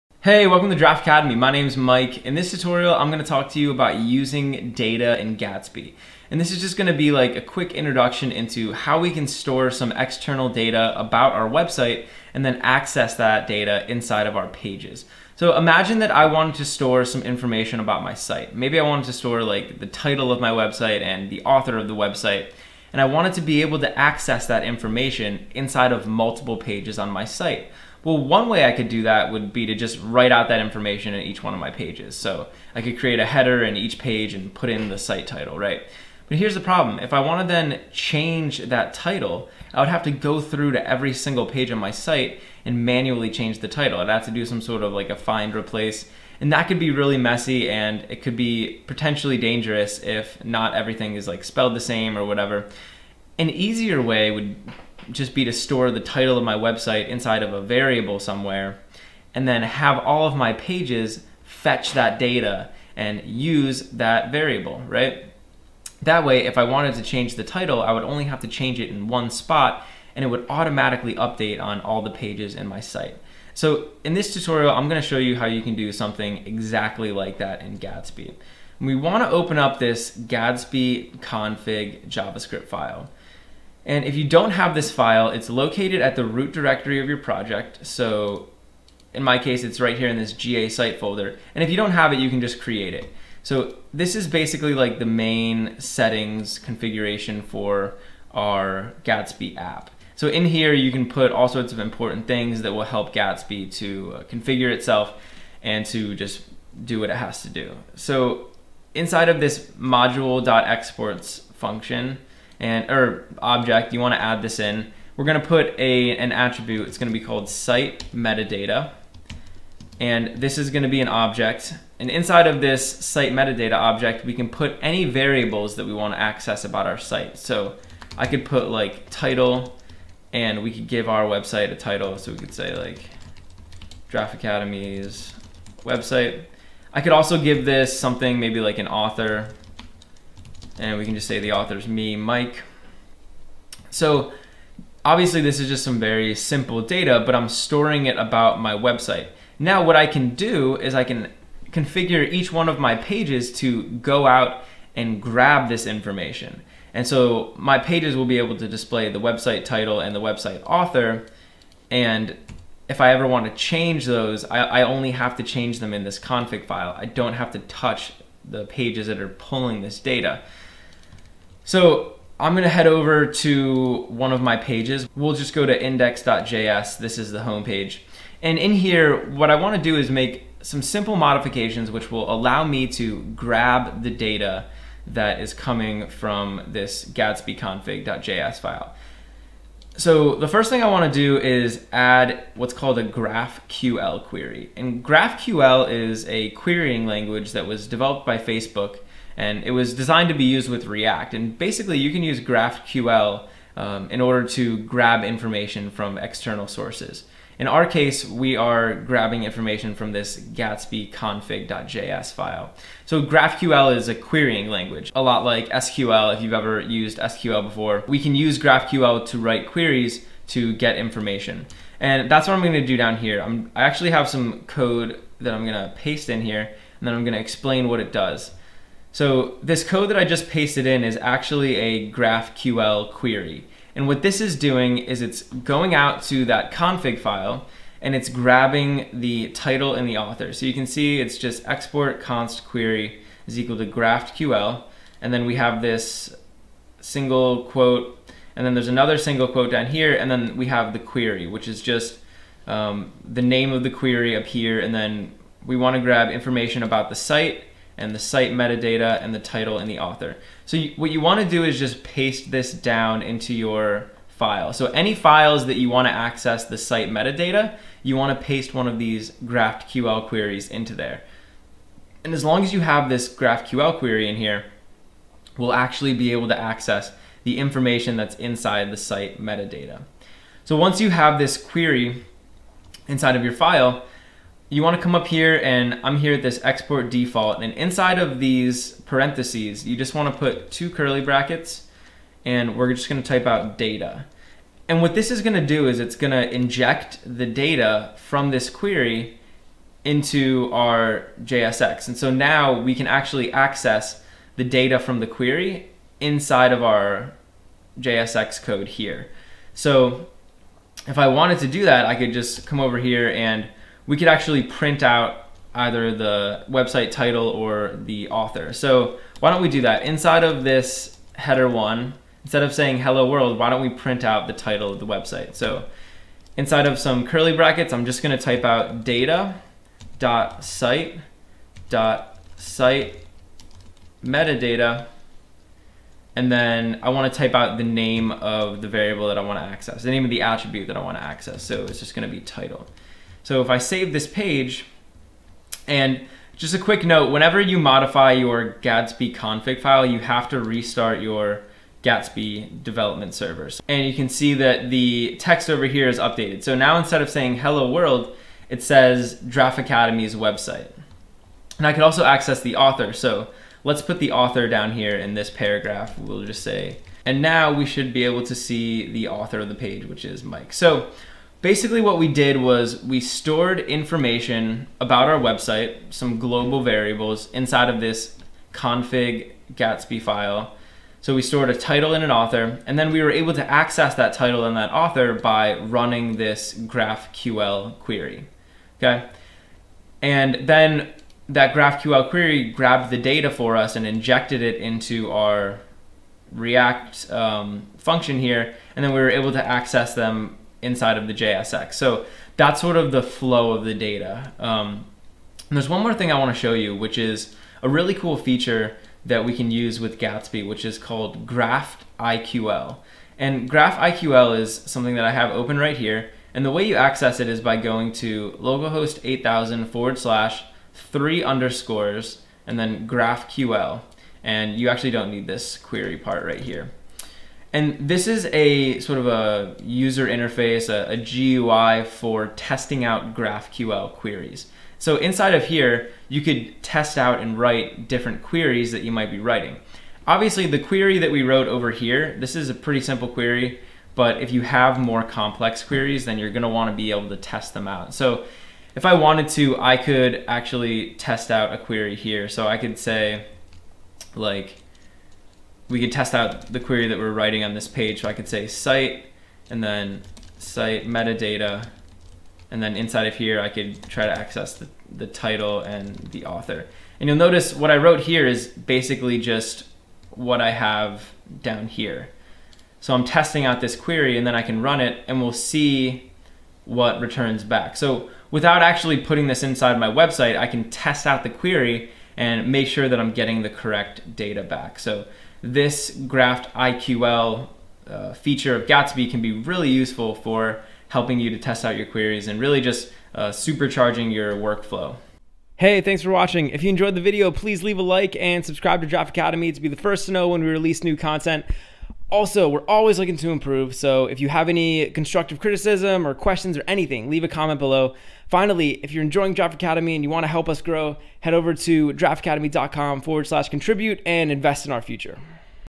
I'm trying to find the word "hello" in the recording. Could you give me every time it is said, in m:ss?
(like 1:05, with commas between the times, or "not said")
5:22, 5:57.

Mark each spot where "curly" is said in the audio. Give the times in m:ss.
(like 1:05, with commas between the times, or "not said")
4:50, 5:27.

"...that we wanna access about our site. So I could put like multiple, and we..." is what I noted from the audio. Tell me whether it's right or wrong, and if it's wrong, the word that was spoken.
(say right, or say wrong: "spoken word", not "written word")
wrong: "title", not "multiple".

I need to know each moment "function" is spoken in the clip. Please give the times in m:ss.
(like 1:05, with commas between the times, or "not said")
1:51, 6:37.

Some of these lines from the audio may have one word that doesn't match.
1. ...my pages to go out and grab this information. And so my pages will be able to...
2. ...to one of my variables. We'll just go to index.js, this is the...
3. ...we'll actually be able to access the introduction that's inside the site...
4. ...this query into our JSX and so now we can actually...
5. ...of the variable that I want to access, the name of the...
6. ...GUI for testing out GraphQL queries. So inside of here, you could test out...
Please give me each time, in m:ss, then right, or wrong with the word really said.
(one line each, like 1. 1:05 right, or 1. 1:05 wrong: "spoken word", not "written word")
1. 2:32 right
2. 2:53 wrong: "pages", not "variables"
3. 4:35 wrong: "information", not "introduction"
4. 4:58 right
5. 5:38 right
6. 7:11 right.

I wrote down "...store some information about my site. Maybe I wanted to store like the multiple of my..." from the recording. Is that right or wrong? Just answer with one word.
wrong.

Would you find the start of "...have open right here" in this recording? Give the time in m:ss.
6:55.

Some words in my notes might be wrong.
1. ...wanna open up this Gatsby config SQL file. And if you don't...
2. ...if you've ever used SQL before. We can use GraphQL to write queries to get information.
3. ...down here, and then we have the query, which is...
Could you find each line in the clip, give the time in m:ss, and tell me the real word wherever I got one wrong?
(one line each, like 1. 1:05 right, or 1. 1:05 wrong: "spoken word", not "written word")
1. 1:18 wrong: "JavaScript", not "SQL"
2. 3:36 right
3. 4:09 right.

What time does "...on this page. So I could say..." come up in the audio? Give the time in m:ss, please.
7:37.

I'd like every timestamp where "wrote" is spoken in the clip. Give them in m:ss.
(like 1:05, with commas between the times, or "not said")
7:21, 7:47.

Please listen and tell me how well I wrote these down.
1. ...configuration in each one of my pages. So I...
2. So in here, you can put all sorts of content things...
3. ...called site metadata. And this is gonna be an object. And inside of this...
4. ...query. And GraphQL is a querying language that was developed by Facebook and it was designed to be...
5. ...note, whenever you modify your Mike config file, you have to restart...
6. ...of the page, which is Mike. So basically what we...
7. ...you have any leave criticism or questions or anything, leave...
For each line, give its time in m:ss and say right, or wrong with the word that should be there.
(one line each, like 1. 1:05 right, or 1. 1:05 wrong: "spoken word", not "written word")
1. 0:30 wrong: "information", not "configuration"
2. 1:40 wrong: "important", not "content"
3. 1:57 right
4. 3:14 right
5. 5:47 wrong: "Gatsby", not "Mike"
6. 6:09 right
7. 8:24 wrong: "constructive", not "leave".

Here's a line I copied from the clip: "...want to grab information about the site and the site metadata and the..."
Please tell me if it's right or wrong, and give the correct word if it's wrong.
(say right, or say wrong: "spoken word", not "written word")
right.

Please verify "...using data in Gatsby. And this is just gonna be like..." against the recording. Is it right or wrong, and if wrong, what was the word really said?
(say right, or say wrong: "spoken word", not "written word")
right.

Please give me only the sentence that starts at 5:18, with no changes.
So why don't we do that?